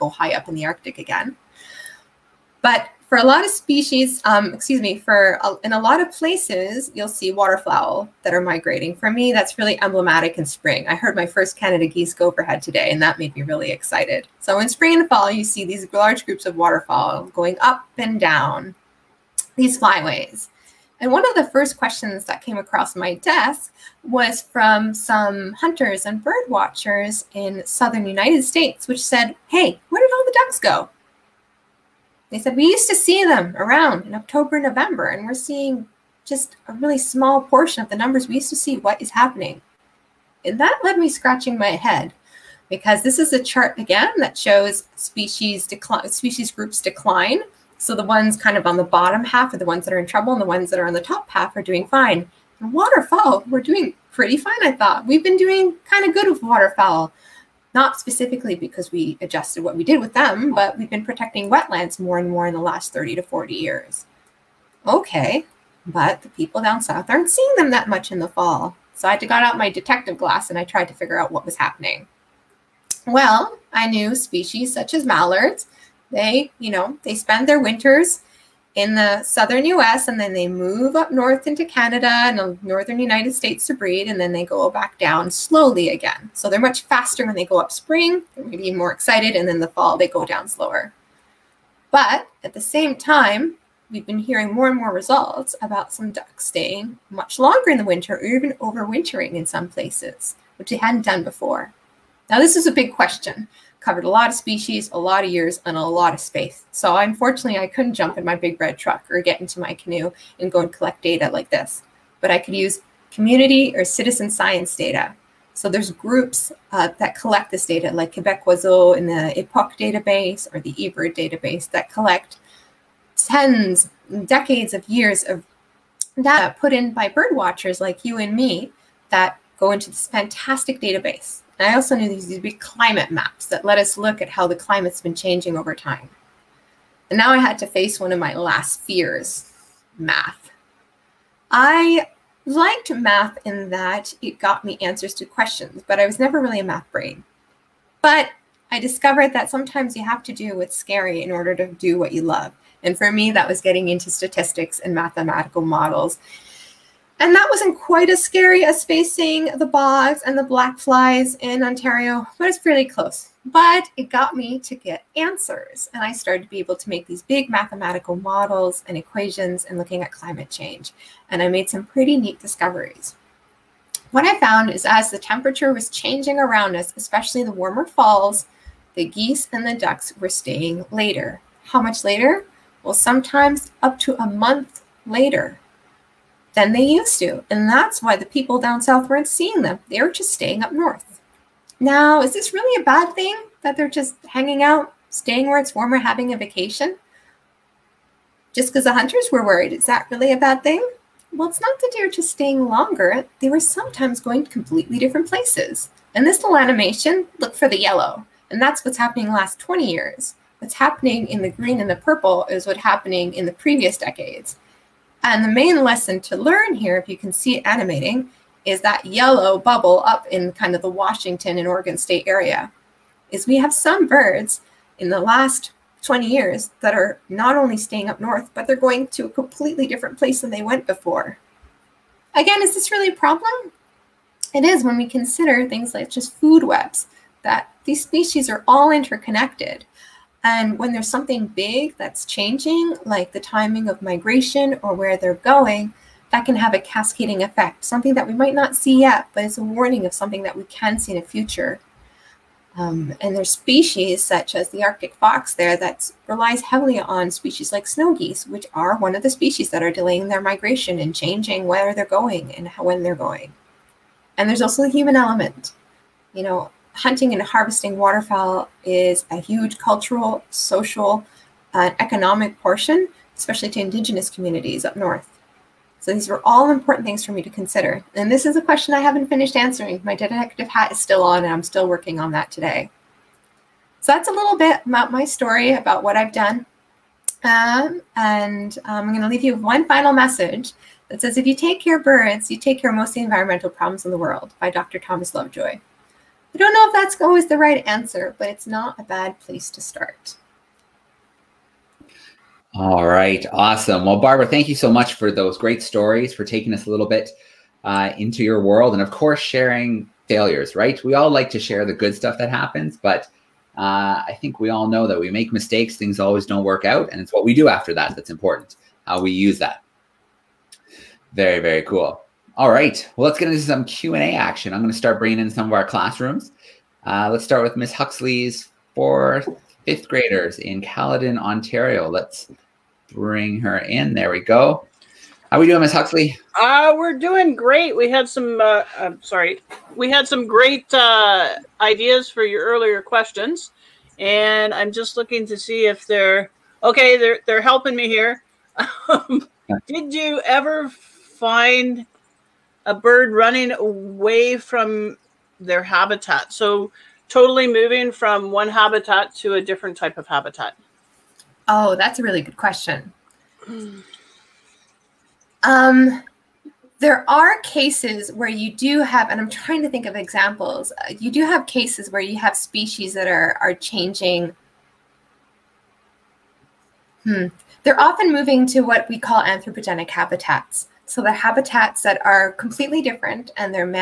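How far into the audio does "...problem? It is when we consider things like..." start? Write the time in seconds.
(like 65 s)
233 s.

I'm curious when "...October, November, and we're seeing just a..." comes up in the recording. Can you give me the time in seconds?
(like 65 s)
34 s.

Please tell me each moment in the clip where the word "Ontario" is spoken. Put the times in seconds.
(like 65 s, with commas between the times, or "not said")
161 s, 331 s.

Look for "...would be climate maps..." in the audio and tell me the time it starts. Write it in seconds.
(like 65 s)
132 s.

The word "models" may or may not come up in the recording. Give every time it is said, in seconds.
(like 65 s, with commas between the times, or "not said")
155 s, 168 s.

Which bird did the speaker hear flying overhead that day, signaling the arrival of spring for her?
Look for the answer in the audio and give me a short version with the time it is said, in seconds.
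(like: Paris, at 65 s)
Canada geese, at 11 s.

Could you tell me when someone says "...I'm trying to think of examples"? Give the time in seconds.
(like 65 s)
369 s.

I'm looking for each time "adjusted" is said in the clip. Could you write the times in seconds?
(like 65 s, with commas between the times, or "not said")
59 s.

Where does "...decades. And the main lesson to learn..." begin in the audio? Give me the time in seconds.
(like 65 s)
213 s.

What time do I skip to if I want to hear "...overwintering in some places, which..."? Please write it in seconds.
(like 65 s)
98 s.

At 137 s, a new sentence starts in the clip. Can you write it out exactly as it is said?
And now I had to face one of my last fears, math.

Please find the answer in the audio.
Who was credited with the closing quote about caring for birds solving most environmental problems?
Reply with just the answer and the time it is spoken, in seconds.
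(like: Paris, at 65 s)
Dr. Thomas Lovejoy, at 294 s.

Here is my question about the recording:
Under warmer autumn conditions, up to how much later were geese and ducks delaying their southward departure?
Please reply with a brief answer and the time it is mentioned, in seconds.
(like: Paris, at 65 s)
a month, at 184 s.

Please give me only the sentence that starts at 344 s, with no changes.
And I'm just looking to see if they're, okay, they're, they're helping me here.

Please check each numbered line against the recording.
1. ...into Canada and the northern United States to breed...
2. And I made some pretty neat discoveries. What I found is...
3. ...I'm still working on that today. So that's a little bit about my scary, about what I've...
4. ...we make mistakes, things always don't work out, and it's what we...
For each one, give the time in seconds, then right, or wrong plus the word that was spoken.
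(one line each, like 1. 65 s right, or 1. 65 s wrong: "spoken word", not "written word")
1. 81 s right
2. 171 s right
3. 281 s wrong: "story", not "scary"
4. 315 s right.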